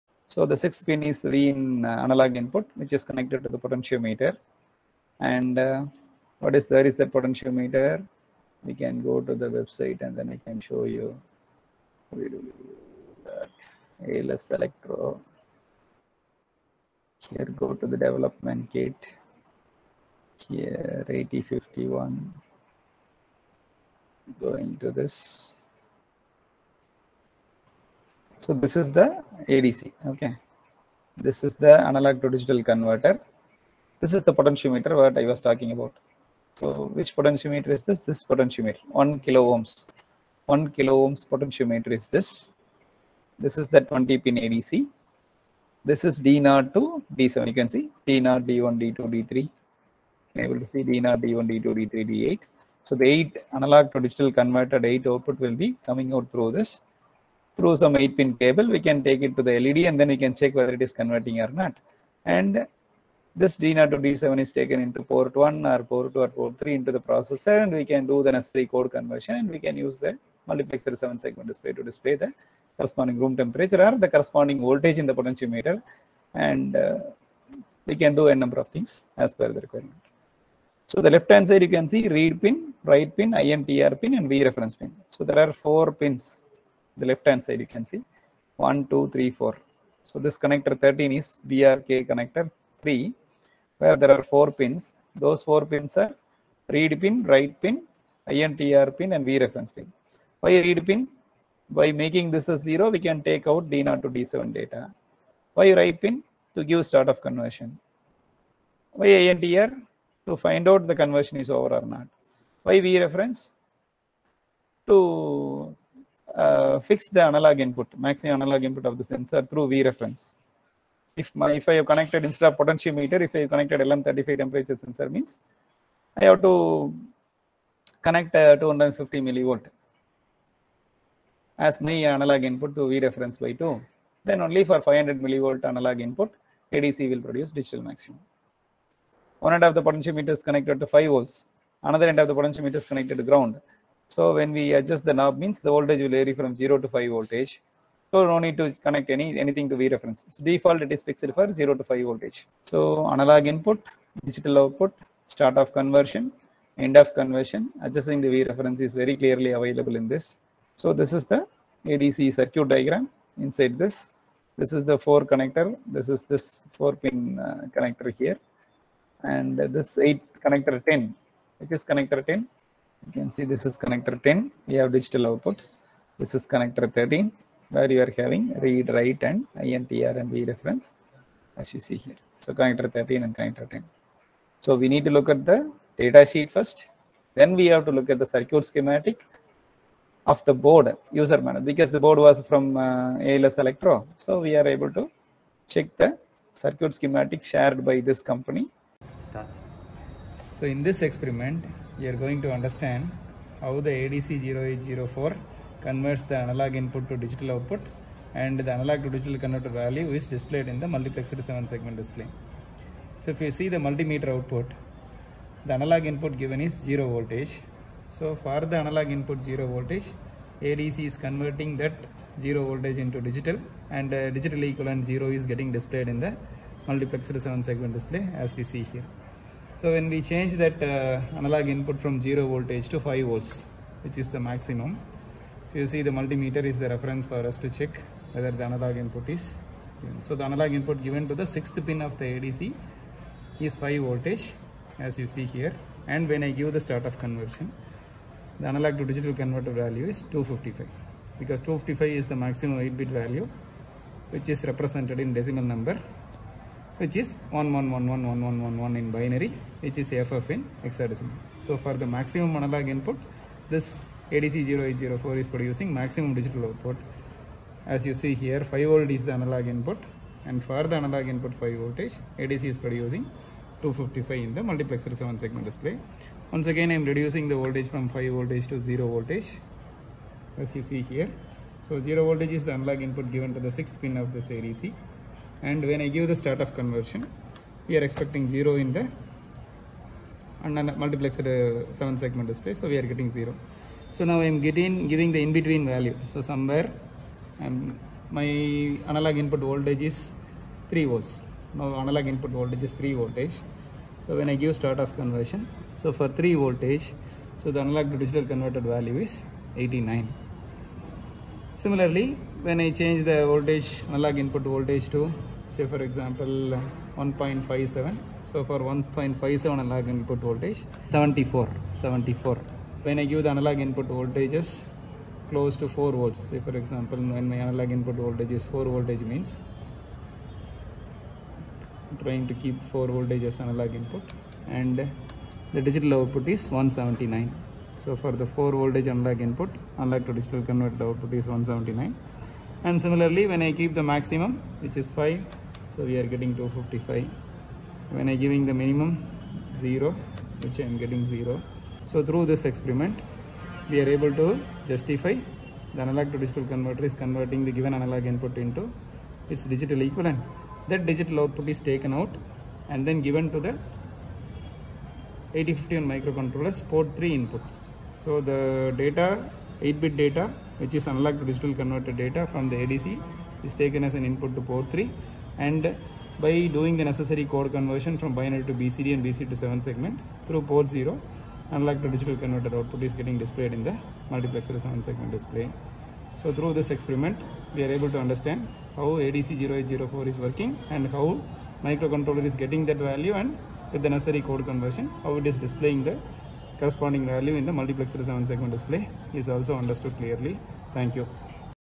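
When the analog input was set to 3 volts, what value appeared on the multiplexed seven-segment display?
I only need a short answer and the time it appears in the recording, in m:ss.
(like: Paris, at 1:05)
89, at 5:09.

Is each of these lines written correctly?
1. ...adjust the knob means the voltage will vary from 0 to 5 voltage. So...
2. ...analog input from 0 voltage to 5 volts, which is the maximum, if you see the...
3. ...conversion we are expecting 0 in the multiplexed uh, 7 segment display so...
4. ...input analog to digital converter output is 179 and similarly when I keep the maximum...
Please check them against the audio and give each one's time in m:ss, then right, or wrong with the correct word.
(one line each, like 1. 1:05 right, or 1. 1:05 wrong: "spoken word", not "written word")
1. 2:24 right
2. 3:51 right
3. 4:46 right
4. 5:39 right.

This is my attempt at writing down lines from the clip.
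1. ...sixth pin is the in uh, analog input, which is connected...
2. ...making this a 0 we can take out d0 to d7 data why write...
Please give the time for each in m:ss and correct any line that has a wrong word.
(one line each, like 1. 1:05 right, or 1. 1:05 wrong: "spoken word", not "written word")
1. 0:00 right
2. 1:42 right.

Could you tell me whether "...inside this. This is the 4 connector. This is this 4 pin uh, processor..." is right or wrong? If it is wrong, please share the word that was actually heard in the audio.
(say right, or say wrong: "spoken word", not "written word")
wrong: "connector", not "processor".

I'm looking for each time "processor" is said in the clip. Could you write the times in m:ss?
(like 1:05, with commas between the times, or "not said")
1:07.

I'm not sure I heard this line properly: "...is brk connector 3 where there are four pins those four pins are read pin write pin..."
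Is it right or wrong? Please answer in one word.
right.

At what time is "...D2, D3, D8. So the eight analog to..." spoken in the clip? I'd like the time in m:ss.
0:51.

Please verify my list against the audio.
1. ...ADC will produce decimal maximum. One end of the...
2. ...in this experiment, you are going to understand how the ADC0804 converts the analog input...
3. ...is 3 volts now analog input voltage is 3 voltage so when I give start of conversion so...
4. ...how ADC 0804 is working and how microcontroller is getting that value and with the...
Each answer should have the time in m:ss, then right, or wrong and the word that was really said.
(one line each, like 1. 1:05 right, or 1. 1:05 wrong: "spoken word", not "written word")
1. 2:16 wrong: "digital", not "decimal"
2. 3:20 right
3. 5:00 right
4. 6:28 right.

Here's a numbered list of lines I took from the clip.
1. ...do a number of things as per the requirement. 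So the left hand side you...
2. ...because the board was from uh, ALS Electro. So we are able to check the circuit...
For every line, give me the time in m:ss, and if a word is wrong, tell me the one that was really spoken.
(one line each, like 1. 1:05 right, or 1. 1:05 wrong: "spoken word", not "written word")
1. 1:18 right
2. 3:11 right.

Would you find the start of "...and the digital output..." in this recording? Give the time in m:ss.
5:34.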